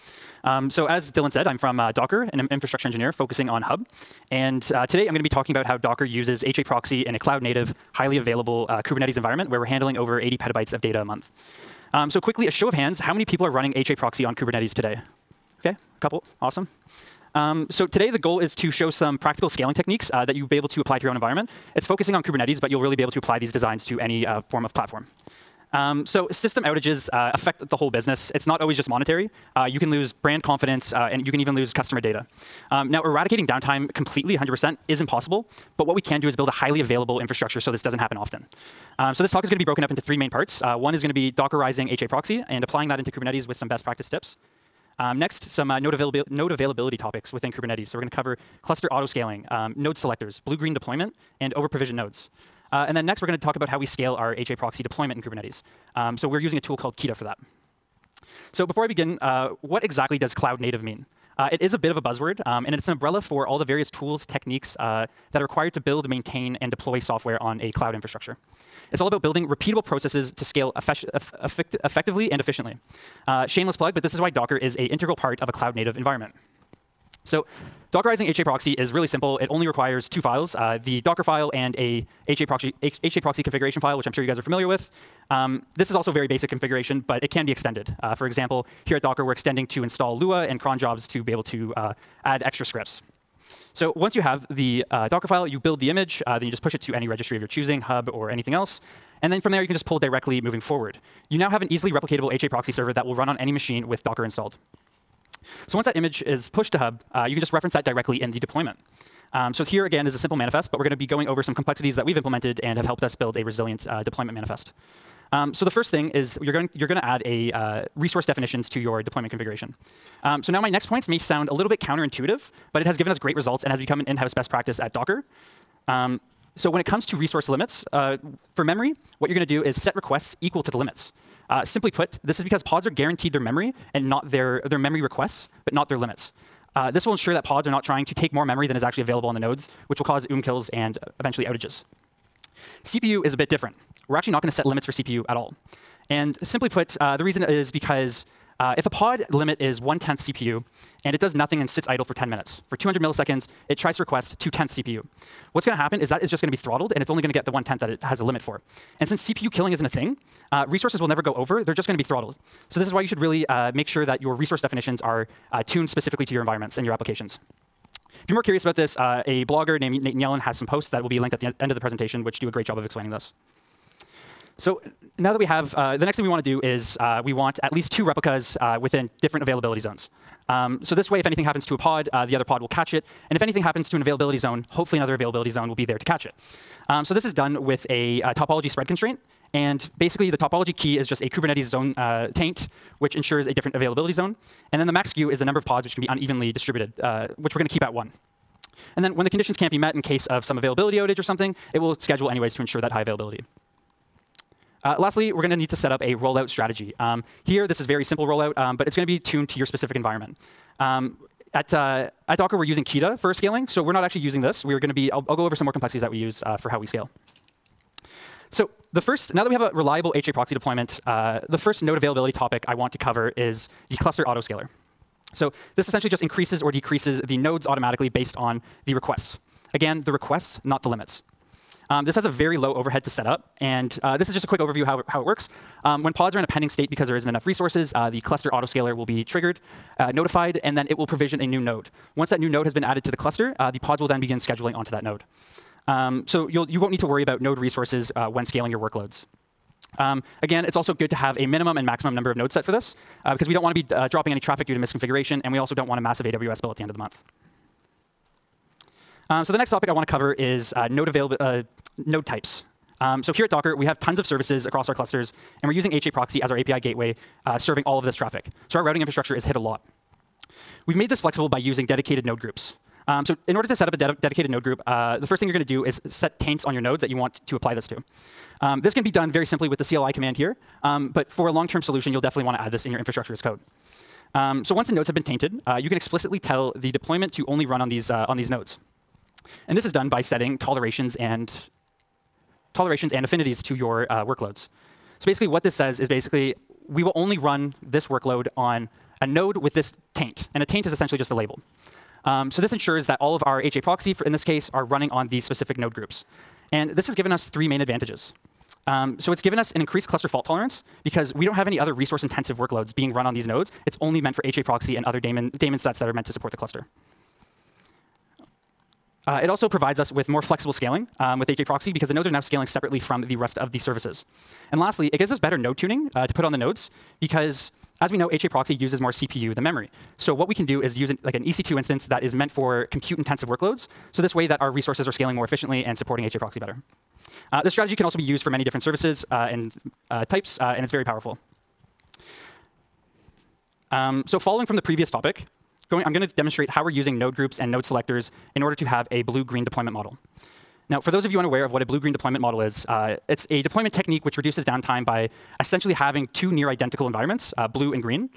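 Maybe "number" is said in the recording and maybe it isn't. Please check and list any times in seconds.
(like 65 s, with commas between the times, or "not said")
195 s, 252 s.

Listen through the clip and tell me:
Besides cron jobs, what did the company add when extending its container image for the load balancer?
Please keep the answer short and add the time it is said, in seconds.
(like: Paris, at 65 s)
Lua, at 90 s.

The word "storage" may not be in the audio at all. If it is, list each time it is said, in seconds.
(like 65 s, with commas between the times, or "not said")
not said.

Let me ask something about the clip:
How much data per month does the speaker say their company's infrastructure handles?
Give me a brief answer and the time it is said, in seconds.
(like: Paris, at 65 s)
over 80 petabytes, at 9 s.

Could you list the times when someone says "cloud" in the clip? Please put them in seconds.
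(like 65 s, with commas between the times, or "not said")
7 s, 60 s, 67 s, 75 s.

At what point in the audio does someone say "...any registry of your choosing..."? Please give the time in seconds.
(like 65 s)
96 s.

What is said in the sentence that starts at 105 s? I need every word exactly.
So once that image is pushed to Hub, uh, you can just reference that directly in the deployment.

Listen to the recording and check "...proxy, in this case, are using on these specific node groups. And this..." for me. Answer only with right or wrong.
wrong.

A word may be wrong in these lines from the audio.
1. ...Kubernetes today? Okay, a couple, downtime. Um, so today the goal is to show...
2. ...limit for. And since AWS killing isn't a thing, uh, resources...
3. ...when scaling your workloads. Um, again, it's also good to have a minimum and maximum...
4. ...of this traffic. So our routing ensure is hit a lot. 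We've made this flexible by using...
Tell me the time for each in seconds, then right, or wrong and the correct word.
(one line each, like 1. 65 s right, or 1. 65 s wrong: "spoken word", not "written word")
1. 14 s wrong: "awesome", not "downtime"
2. 158 s wrong: "CPU", not "AWS"
3. 248 s right
4. 267 s wrong: "infrastructure", not "ensure".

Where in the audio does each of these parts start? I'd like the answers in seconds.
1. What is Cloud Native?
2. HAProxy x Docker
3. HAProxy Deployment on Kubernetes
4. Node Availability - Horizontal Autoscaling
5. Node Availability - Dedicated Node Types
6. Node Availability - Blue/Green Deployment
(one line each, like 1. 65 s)
1. 58 s
2. 76 s
3. 125 s
4. 217 s
5. 258 s
6. 341 s.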